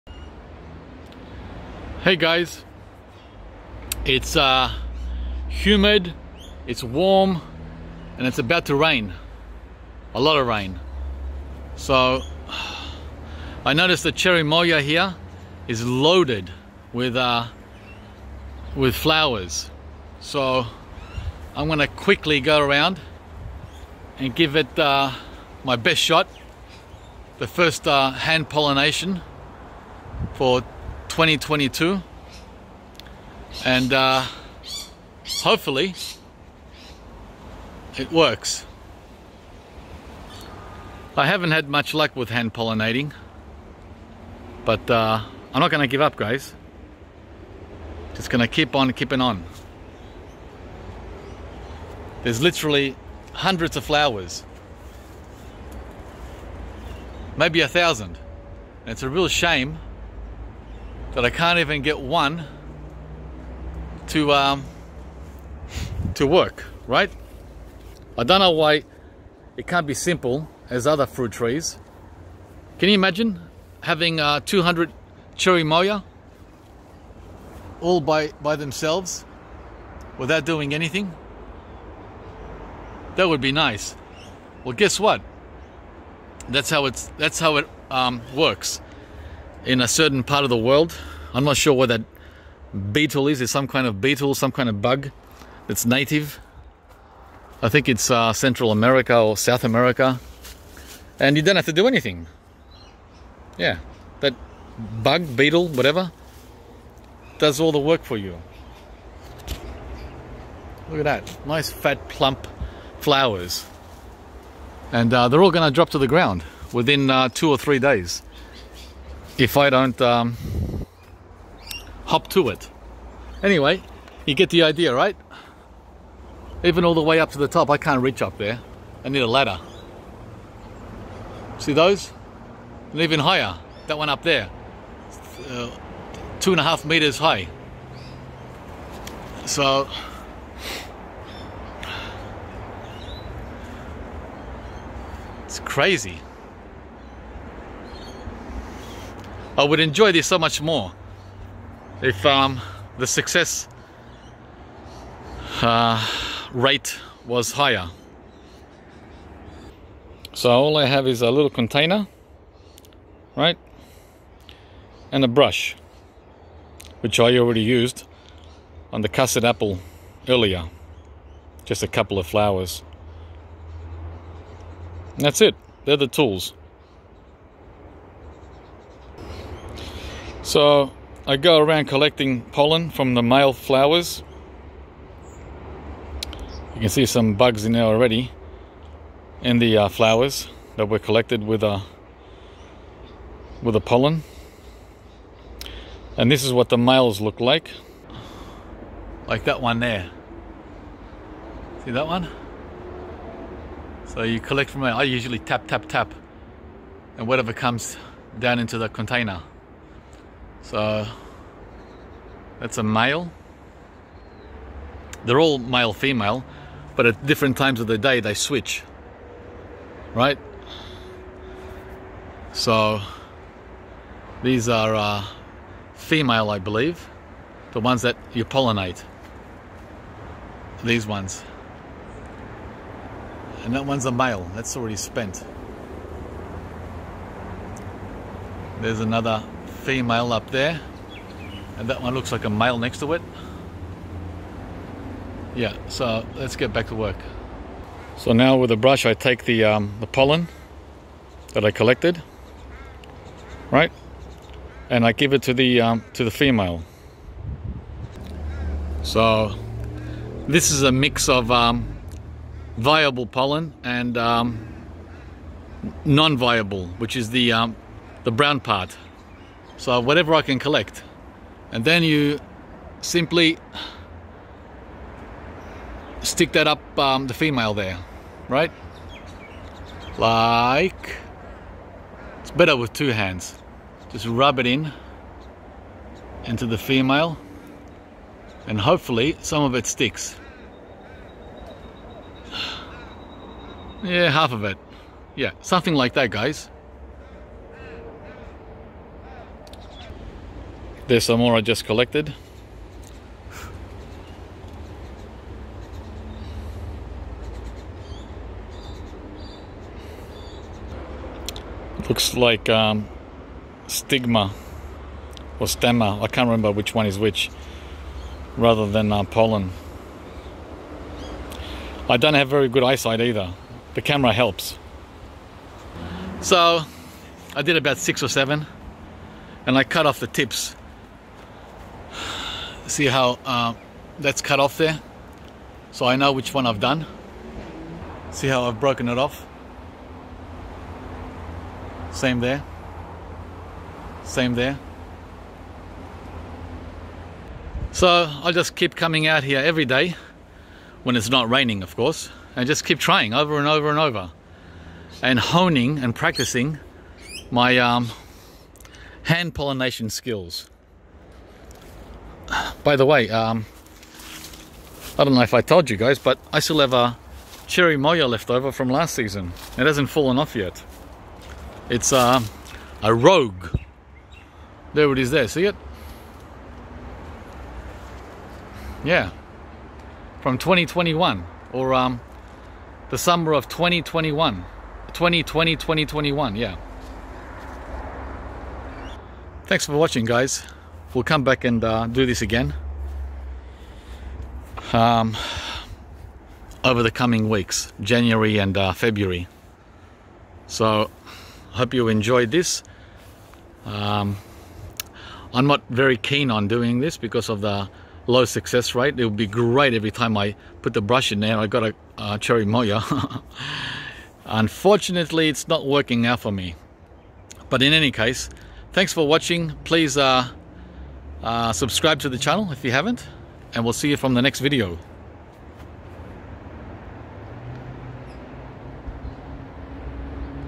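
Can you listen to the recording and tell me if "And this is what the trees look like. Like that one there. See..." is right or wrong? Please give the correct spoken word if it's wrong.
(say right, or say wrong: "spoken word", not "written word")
wrong: "males", not "trees".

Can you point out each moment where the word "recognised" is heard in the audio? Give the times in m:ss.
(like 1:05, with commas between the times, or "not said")
not said.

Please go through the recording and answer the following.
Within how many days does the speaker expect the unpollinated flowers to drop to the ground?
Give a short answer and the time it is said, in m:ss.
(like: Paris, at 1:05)
2 or 3, at 1:57.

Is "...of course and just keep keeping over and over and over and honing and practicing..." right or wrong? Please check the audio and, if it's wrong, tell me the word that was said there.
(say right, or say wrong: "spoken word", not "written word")
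wrong: "trying", not "keeping".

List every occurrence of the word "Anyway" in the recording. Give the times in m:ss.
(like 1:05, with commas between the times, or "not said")
2:03.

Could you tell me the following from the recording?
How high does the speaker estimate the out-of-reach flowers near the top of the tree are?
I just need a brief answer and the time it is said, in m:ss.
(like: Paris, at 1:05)
2.5 meters, at 2:16.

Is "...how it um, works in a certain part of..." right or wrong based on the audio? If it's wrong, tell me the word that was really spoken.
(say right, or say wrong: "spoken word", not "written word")
right.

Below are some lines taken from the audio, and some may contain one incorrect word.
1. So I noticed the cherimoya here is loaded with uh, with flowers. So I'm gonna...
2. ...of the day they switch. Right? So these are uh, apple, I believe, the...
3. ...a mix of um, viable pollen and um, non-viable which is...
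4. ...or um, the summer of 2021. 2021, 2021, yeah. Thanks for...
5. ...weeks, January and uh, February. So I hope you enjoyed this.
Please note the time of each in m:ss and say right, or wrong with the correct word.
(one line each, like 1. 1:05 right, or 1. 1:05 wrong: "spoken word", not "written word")
1. 0:11 right
2. 3:37 wrong: "female", not "apple"
3. 4:20 right
4. 6:21 wrong: "2020", not "2021"
5. 6:37 right.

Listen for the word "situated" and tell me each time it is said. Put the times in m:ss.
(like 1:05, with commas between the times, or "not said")
not said.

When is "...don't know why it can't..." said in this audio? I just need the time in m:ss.
1:08.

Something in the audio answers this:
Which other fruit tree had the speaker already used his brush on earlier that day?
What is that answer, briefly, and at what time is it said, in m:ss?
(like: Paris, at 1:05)
Custard apple, at 2:49.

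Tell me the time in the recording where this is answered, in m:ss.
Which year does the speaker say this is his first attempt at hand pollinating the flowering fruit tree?
0:31.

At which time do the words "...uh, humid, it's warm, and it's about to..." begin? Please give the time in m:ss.
0:04.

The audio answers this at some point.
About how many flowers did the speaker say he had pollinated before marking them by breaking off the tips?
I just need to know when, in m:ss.
5:27.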